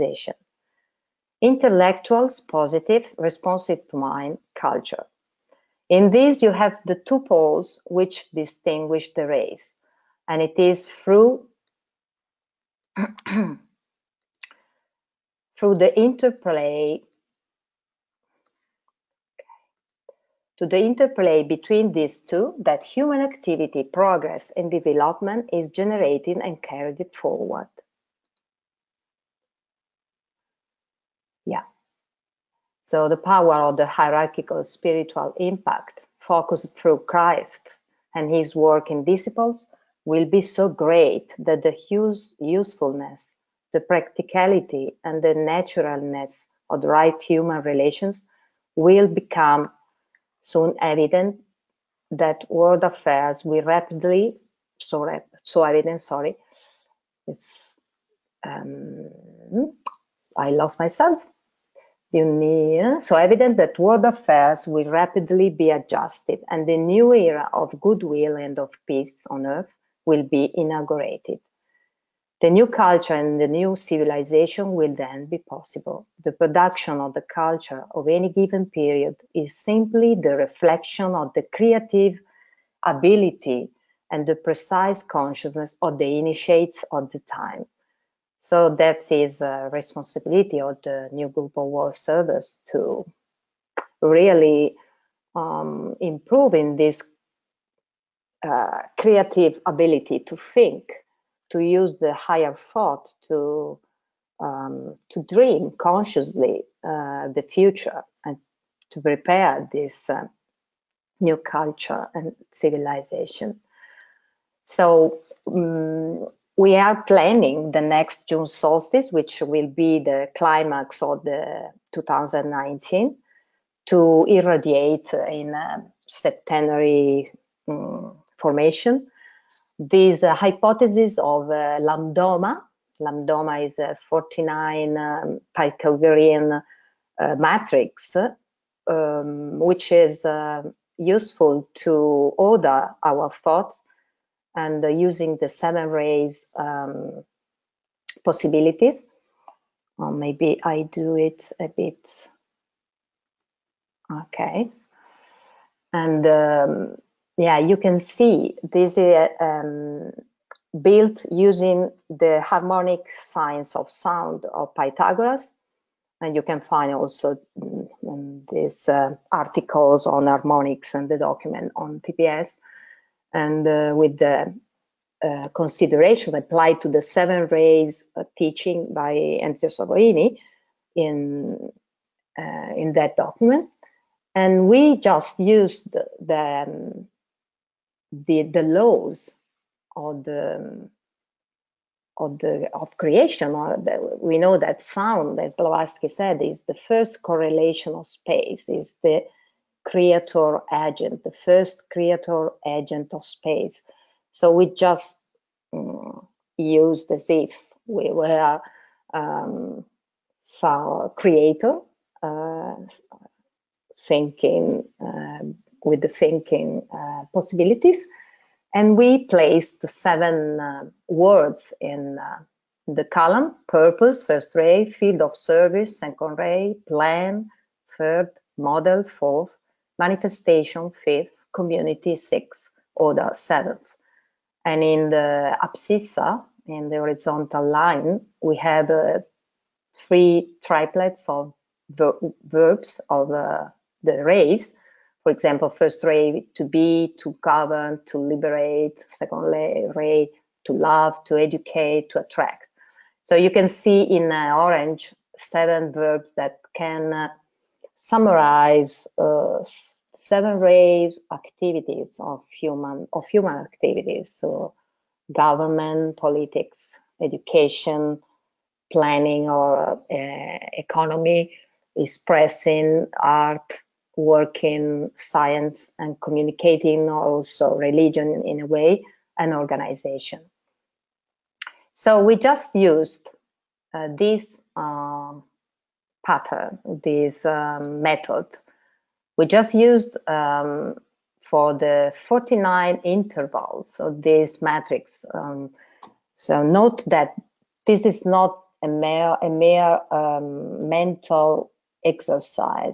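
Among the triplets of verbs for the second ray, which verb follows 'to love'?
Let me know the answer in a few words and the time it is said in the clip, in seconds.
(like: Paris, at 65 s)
to educate, at 251 s.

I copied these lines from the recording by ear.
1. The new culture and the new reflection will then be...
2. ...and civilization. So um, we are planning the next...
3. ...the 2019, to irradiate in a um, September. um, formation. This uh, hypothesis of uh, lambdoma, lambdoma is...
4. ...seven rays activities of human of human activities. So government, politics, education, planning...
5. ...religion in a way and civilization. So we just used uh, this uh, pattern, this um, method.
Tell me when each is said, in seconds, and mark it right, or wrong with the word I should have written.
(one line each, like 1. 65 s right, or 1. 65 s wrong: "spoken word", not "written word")
1. 72 s wrong: "civilization", not "reflection"
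2. 112 s right
3. 121 s right
4. 260 s right
5. 277 s wrong: "organization", not "civilization".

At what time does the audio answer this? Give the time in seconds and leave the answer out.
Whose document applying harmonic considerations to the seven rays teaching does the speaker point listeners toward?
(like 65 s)
179 s.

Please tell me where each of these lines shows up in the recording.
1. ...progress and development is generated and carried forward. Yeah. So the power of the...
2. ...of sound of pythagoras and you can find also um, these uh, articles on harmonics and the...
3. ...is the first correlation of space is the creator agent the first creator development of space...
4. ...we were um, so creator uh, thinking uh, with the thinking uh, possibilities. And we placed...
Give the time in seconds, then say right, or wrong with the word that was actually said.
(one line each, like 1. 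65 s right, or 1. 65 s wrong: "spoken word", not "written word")
1. 23 s right
2. 163 s right
3. 196 s wrong: "agent", not "development"
4. 207 s right.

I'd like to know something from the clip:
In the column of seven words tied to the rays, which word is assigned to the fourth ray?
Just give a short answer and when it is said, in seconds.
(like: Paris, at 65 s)
model, at 228 s.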